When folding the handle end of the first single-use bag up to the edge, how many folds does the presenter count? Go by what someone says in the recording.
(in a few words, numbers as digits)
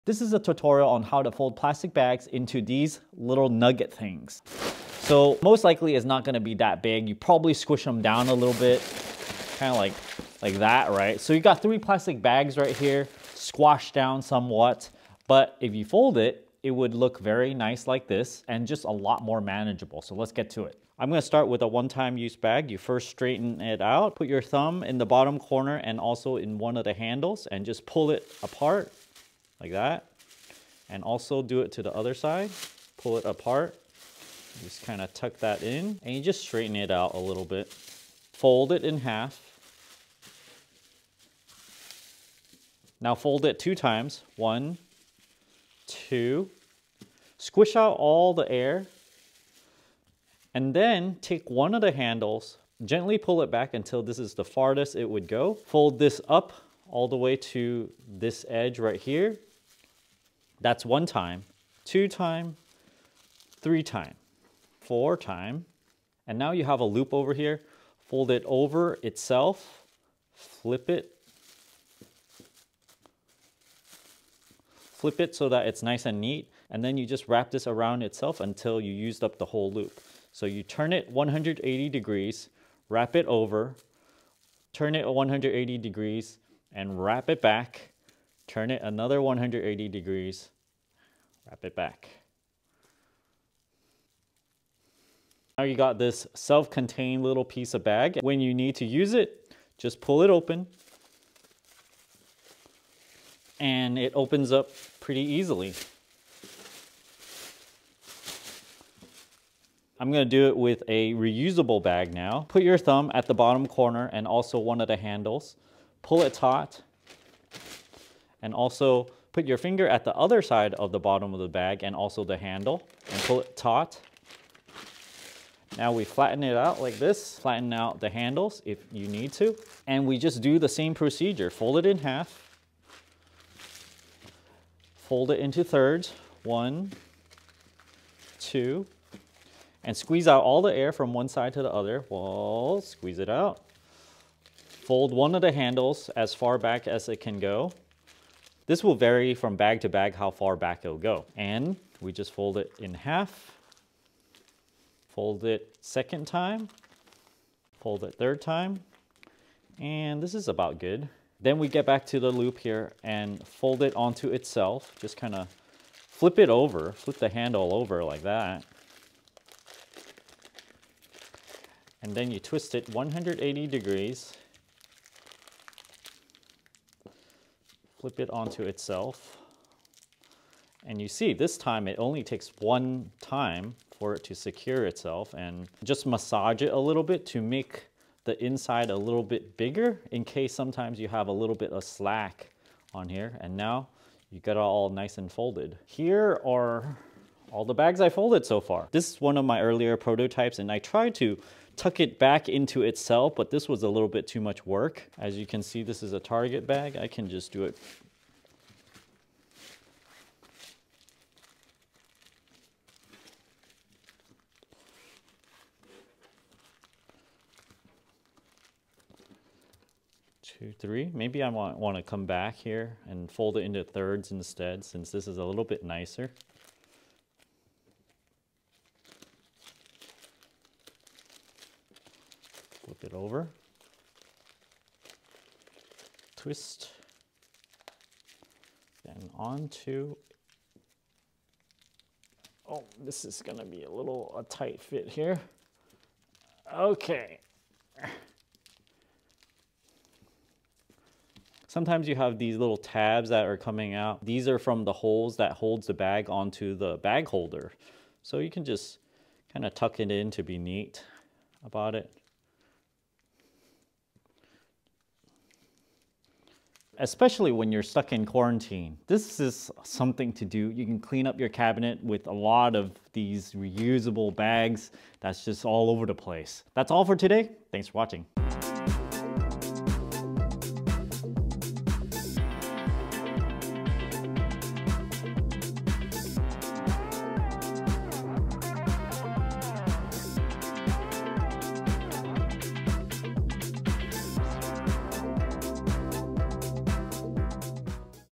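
4.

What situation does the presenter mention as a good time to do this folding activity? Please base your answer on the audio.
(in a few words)
quarantine.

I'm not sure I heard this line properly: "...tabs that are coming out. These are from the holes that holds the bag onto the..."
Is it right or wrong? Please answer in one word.
right.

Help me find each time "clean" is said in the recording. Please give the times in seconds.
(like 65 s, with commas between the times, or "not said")
270 s.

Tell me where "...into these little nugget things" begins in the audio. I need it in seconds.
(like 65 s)
2 s.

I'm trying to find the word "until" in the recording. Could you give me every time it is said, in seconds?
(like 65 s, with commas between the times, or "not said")
53 s, 78 s.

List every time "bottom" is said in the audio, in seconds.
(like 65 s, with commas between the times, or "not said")
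25 s, 113 s, 120 s.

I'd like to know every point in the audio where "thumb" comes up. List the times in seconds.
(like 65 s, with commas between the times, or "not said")
24 s, 112 s.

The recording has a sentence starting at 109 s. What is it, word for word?
I'm gonna do it with a reusable bag now.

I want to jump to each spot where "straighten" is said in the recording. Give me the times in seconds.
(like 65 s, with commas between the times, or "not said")
23 s, 36 s.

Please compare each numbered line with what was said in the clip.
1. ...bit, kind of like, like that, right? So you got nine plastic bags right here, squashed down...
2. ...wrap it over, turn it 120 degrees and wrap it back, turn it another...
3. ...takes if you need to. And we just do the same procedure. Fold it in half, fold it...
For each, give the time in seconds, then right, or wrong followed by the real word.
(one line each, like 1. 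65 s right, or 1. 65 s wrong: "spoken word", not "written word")
1. 8 s wrong: "three", not "nine"
2. 82 s wrong: "180", not "120"
3. 128 s wrong: "handles", not "takes".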